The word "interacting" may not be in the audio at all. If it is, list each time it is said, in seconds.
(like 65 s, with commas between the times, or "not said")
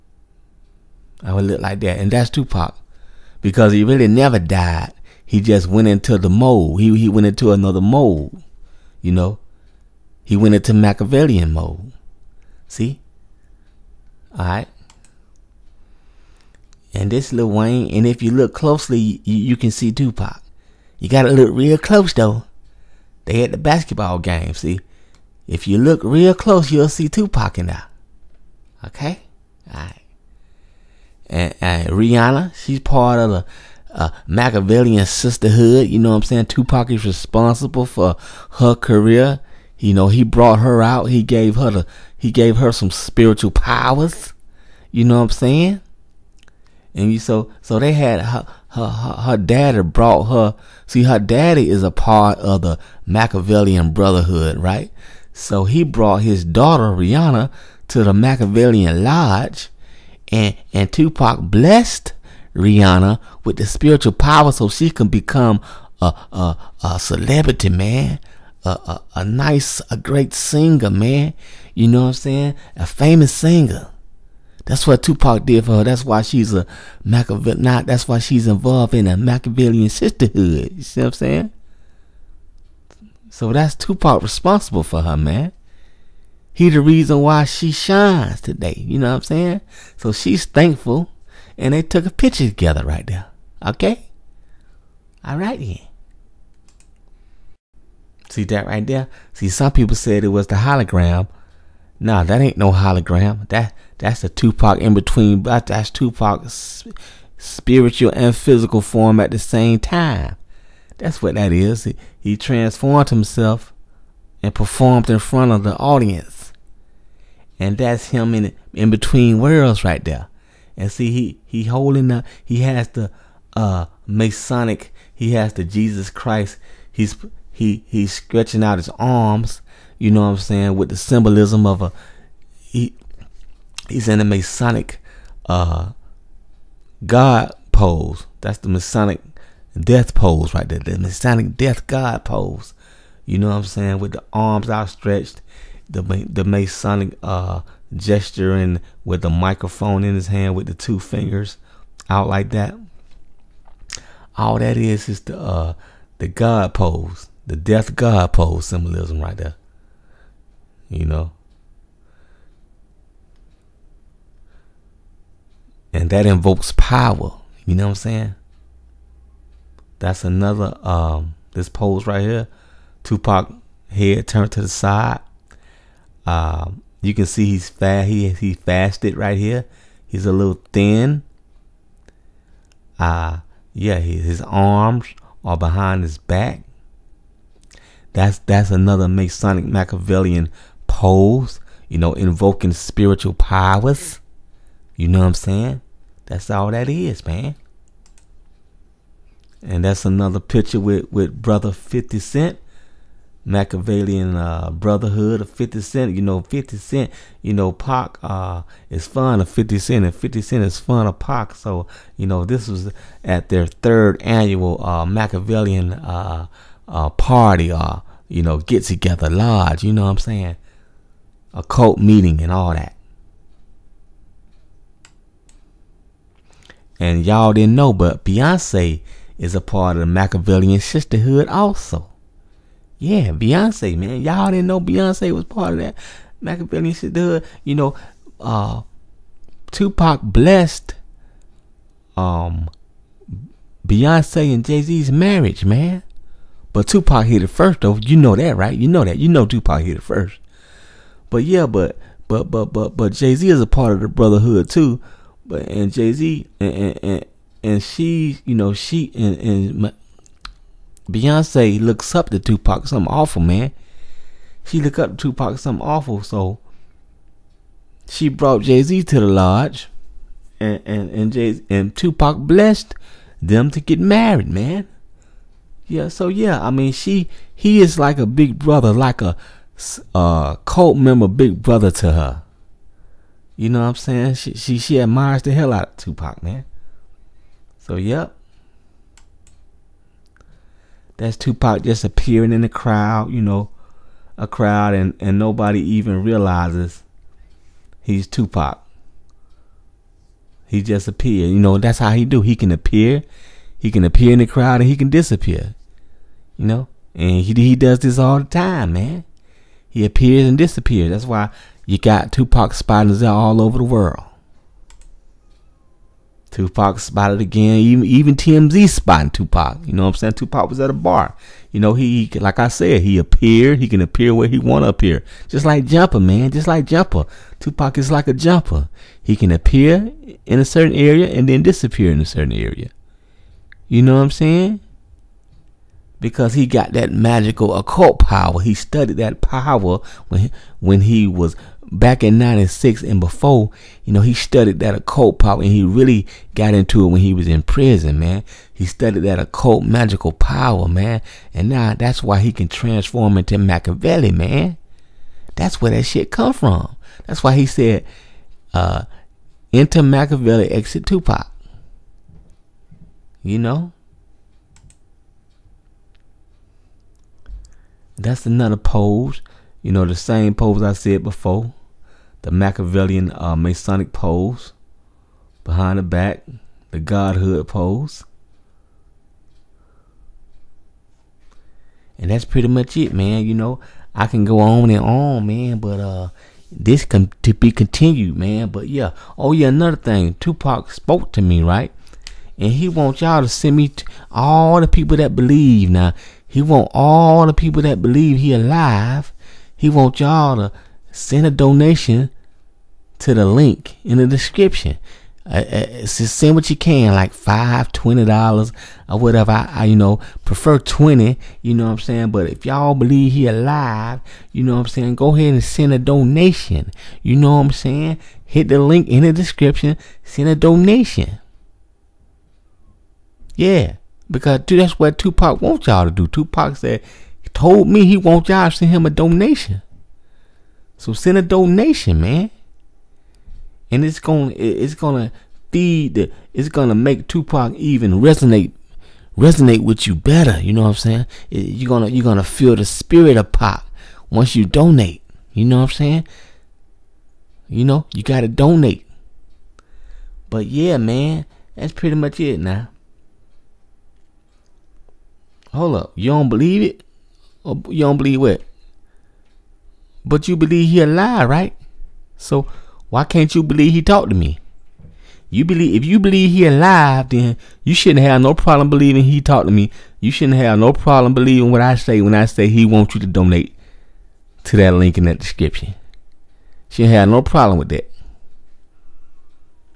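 not said.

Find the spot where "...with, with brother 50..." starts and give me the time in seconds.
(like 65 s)
200 s.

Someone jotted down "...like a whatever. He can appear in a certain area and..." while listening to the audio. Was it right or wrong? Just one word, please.
wrong.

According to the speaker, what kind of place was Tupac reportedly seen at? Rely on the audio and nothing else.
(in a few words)
a bar.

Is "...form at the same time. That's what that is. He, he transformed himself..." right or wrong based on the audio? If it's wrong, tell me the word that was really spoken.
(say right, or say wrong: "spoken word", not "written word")
right.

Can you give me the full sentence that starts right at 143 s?
With the arms outstretched, the the Masonic uh, gesturing with the microphone in his hand with the two fingers out like that.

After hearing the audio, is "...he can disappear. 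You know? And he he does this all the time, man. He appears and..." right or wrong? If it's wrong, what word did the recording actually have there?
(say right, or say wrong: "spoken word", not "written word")
right.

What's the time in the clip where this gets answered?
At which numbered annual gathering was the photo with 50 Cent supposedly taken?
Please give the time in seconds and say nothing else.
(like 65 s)
213 s.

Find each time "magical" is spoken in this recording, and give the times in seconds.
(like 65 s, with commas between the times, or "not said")
337 s, 349 s.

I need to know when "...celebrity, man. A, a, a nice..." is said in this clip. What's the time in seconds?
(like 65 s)
66 s.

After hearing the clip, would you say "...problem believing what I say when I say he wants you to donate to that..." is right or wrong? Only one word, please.
right.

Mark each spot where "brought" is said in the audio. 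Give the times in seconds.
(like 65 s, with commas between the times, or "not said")
40 s, 49 s, 55 s, 268 s.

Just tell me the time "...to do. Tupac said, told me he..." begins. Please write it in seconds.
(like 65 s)
426 s.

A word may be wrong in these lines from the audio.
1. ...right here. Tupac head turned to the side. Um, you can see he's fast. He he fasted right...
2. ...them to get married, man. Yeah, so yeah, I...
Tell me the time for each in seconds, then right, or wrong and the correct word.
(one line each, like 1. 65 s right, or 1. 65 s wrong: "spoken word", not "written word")
1. 172 s right
2. 273 s right.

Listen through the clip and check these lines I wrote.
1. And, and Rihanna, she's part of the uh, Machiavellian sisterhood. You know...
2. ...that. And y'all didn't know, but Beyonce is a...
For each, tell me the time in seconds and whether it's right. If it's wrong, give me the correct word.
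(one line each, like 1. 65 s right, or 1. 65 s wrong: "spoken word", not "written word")
1. 31 s right
2. 222 s right.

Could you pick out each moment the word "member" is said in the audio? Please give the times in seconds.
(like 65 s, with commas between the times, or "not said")
280 s.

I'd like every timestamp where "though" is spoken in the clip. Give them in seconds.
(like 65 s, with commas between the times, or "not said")
22 s, 247 s.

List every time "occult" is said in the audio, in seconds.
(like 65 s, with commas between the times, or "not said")
337 s, 344 s, 349 s.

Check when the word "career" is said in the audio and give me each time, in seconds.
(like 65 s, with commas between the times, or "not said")
38 s.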